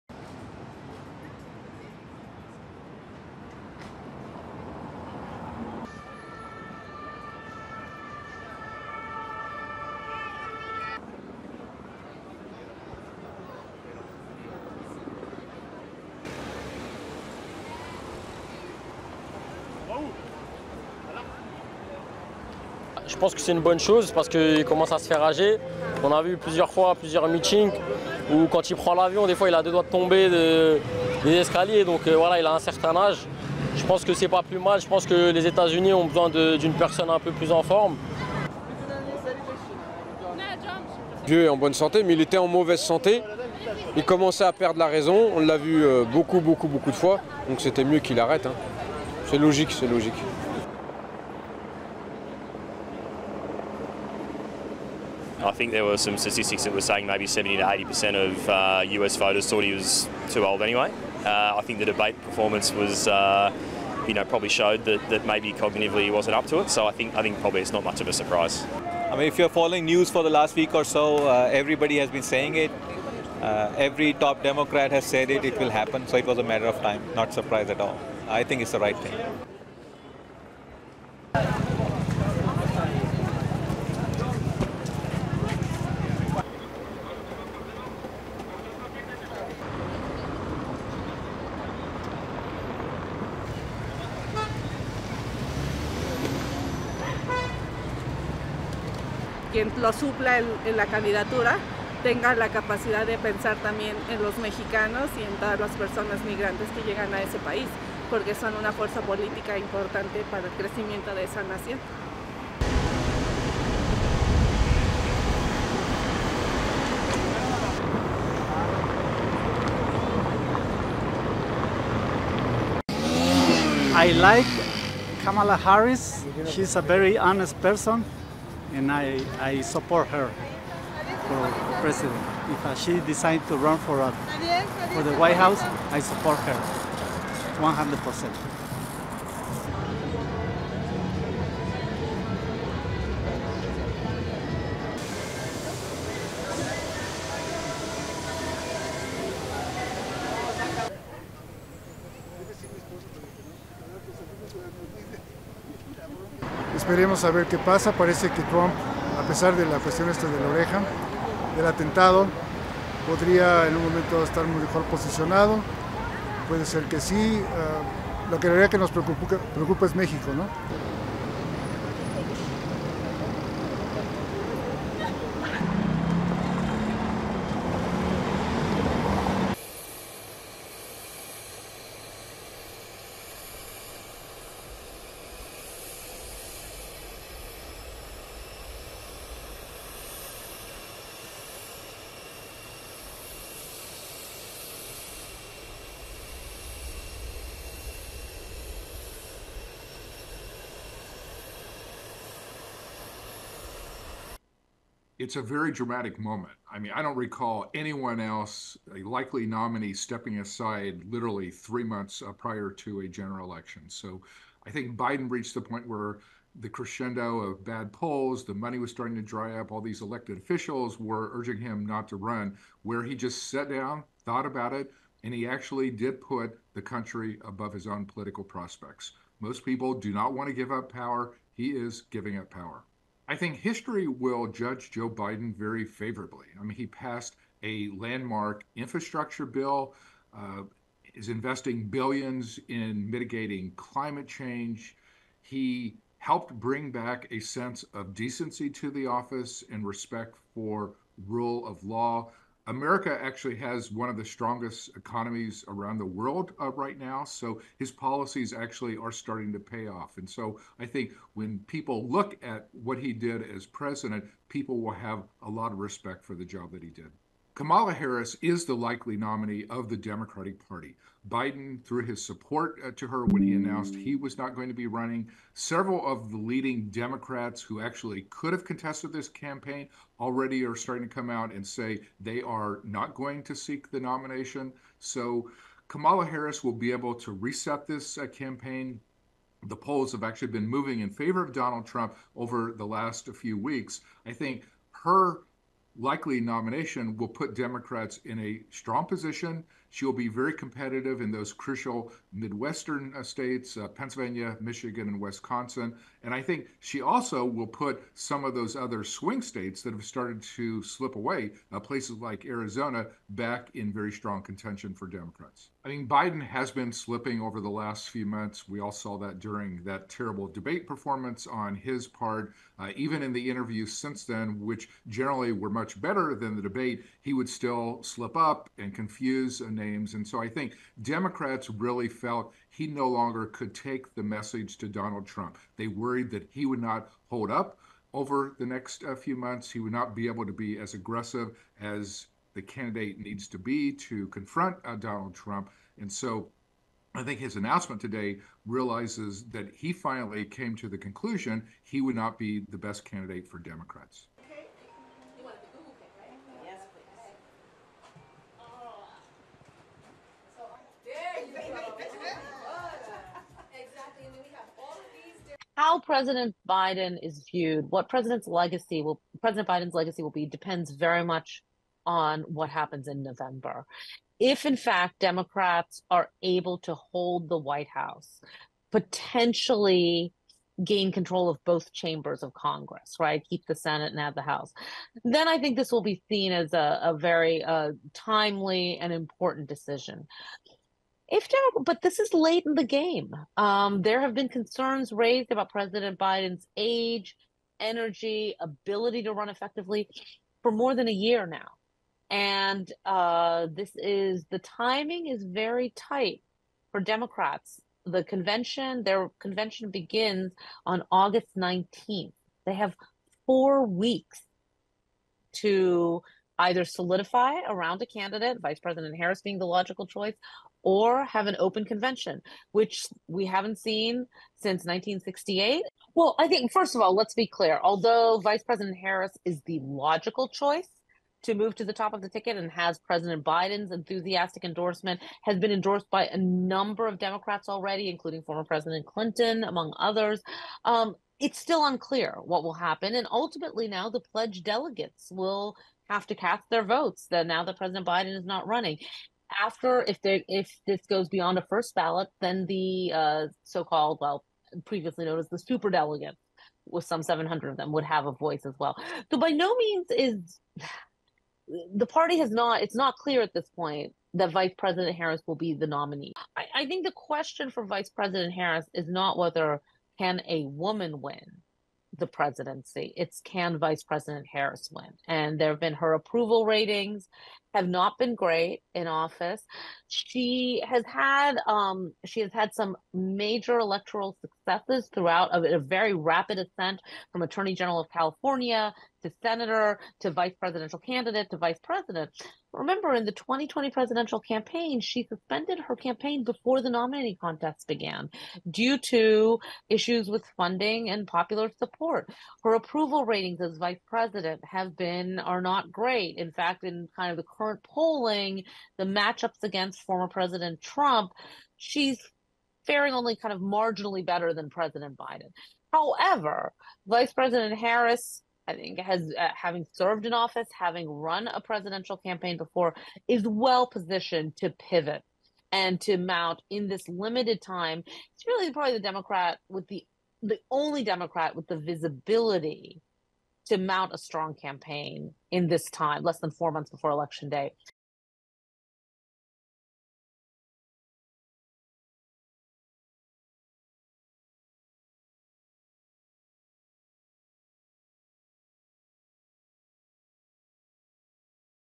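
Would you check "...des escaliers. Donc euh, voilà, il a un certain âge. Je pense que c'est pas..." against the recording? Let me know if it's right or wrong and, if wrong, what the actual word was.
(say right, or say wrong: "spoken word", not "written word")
right.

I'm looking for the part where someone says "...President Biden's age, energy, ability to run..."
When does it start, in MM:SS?
06:35.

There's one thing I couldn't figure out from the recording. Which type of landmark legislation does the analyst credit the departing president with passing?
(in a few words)
infrastructure bill.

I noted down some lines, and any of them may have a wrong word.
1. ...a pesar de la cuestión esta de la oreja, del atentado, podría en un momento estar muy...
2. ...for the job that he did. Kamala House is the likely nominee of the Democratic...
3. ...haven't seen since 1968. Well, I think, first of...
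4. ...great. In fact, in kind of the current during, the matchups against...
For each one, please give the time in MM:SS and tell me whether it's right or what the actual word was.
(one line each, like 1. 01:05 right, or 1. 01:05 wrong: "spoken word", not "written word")
1. 02:39 right
2. 04:26 wrong: "Harris", not "House"
3. 07:03 right
4. 08:25 wrong: "polling", not "during".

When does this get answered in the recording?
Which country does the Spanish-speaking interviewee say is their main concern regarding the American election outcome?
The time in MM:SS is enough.
02:49.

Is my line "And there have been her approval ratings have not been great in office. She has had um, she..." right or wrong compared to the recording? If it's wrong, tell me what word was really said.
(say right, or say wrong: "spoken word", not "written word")
right.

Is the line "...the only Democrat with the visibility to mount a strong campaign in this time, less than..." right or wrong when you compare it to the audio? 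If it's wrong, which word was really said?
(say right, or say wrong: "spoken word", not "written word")
right.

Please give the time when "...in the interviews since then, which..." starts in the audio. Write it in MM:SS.
05:23.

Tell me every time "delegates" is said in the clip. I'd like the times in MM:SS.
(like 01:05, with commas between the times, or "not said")
07:24, 07:35.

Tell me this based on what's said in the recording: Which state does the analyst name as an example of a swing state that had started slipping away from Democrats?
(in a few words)
Arizona.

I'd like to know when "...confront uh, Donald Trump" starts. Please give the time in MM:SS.
05:44.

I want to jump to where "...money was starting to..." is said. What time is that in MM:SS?
03:38.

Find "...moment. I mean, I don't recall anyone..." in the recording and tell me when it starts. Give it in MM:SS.
03:26.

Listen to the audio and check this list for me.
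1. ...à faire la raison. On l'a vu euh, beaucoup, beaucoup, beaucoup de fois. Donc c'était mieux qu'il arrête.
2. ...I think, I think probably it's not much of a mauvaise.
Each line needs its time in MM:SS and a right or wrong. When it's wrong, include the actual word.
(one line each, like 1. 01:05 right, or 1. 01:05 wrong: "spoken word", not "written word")
1. 00:44 wrong: "perdre", not "faire"
2. 01:06 wrong: "surprise", not "mauvaise".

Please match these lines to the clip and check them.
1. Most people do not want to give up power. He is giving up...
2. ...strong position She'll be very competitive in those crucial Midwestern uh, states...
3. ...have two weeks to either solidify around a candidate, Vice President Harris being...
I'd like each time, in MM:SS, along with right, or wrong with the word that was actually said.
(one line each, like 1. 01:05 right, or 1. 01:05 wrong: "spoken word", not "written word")
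1. 03:49 right
2. 04:58 right
3. 06:52 wrong: "four", not "two".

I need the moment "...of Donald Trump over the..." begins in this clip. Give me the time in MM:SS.
04:51.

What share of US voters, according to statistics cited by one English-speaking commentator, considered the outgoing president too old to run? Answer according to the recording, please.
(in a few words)
70 to 80%.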